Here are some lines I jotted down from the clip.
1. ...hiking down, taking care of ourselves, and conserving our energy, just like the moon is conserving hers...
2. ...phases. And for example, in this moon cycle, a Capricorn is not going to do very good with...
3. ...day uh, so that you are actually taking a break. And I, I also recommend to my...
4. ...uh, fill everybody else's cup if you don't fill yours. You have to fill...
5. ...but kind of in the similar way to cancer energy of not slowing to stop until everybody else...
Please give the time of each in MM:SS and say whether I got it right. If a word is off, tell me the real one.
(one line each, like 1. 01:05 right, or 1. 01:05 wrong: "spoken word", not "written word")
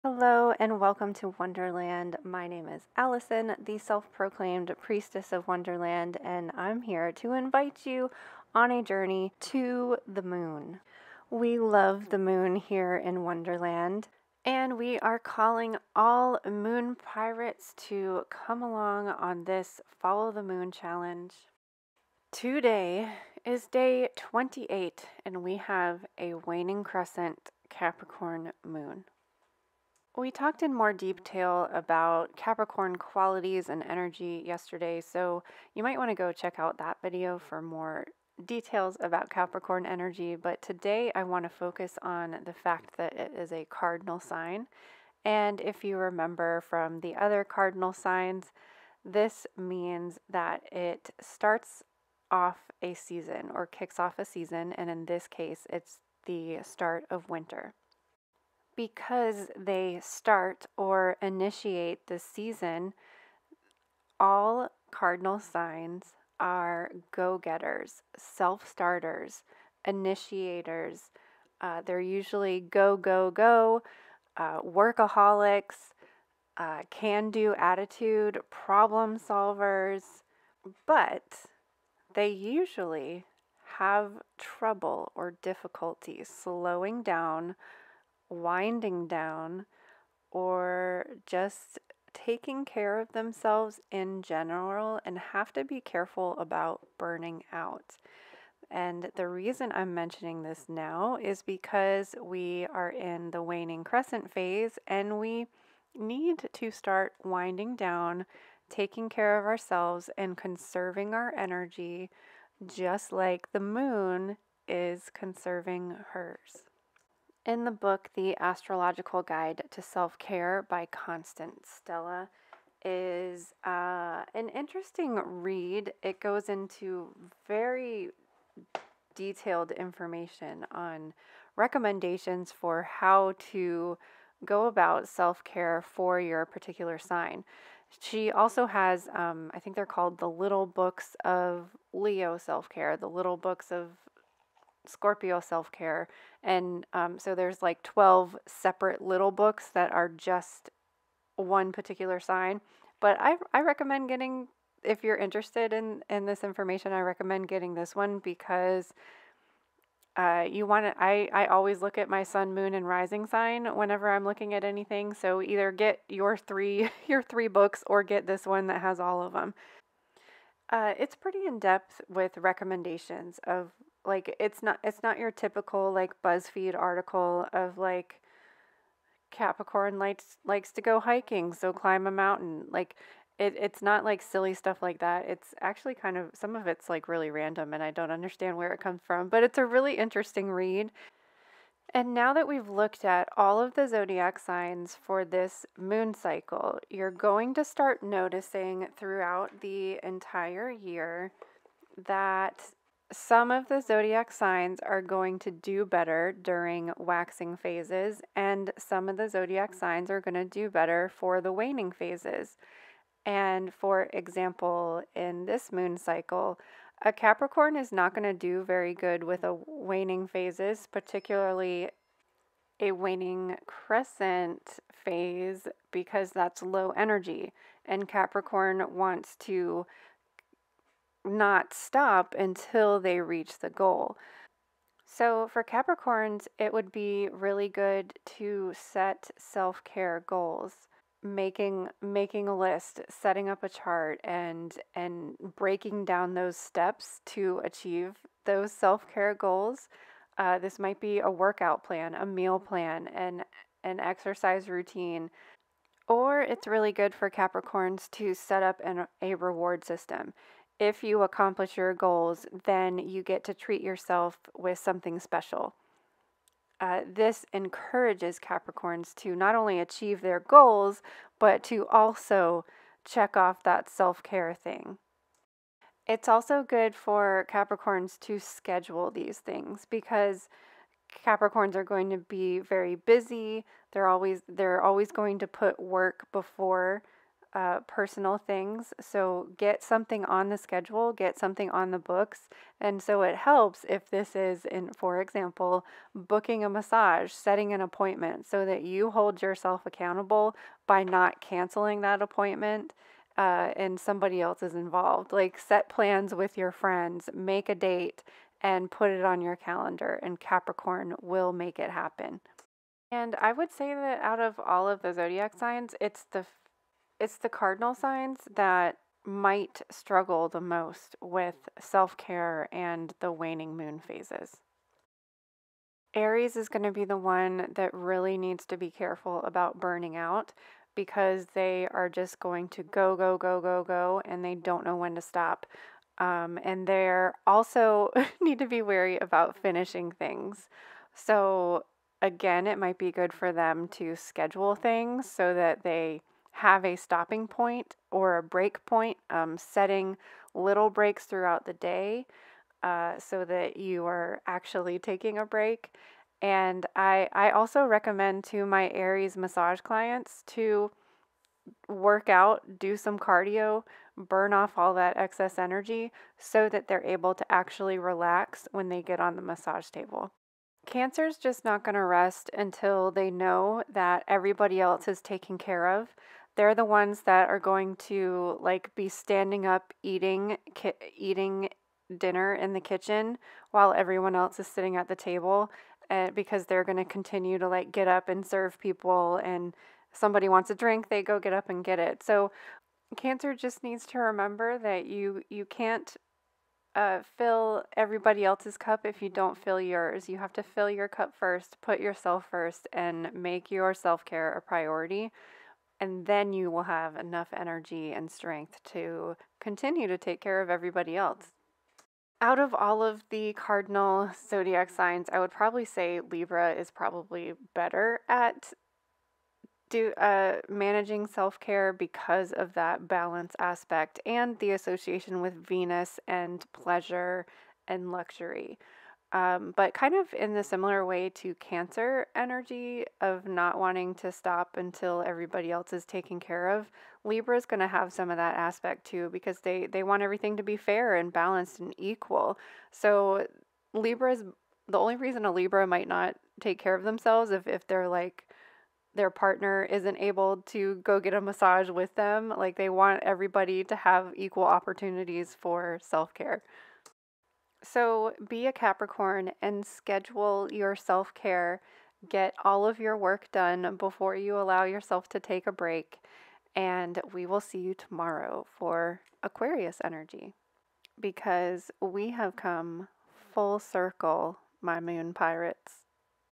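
1. 01:47 wrong: "winding", not "hiking"
2. 03:31 right
3. 05:51 right
4. 06:36 right
5. 07:09 wrong: "wanting", not "slowing".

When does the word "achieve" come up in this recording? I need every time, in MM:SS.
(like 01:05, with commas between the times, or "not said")
04:07, 04:29.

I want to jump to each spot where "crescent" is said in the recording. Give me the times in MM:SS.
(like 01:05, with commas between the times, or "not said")
00:26, 01:43, 03:43.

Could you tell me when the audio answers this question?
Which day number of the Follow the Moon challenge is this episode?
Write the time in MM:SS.
00:23.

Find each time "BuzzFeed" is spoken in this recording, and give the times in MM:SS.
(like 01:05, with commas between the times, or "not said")
02:56.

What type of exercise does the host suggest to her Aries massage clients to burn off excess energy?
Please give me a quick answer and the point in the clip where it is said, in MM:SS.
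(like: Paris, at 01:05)
cardio, at 06:03.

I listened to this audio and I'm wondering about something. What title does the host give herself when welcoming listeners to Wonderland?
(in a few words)
priestess of Wonderland.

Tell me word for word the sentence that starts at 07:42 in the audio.
Get all of your work done before you allow yourself to take a break.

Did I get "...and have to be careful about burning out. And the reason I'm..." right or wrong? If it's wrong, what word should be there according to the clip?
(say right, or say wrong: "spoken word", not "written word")
right.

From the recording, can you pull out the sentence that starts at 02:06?
It goes into very detailed information on recommendations for how to go about self care for your particular sign.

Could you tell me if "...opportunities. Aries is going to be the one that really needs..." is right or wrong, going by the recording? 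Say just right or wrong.
wrong.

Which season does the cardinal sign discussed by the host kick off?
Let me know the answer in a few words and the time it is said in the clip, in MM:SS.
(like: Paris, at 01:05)
winter, at 00:57.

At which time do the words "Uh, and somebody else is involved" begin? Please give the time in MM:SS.
05:03.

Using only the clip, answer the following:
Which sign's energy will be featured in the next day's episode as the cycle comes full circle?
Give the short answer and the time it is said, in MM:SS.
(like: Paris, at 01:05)
Aquarius, at 07:49.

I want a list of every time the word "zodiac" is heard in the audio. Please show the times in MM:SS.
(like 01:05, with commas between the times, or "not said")
03:13, 03:23, 03:29, 05:15, 06:54.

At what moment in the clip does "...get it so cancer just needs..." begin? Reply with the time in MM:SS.
06:31.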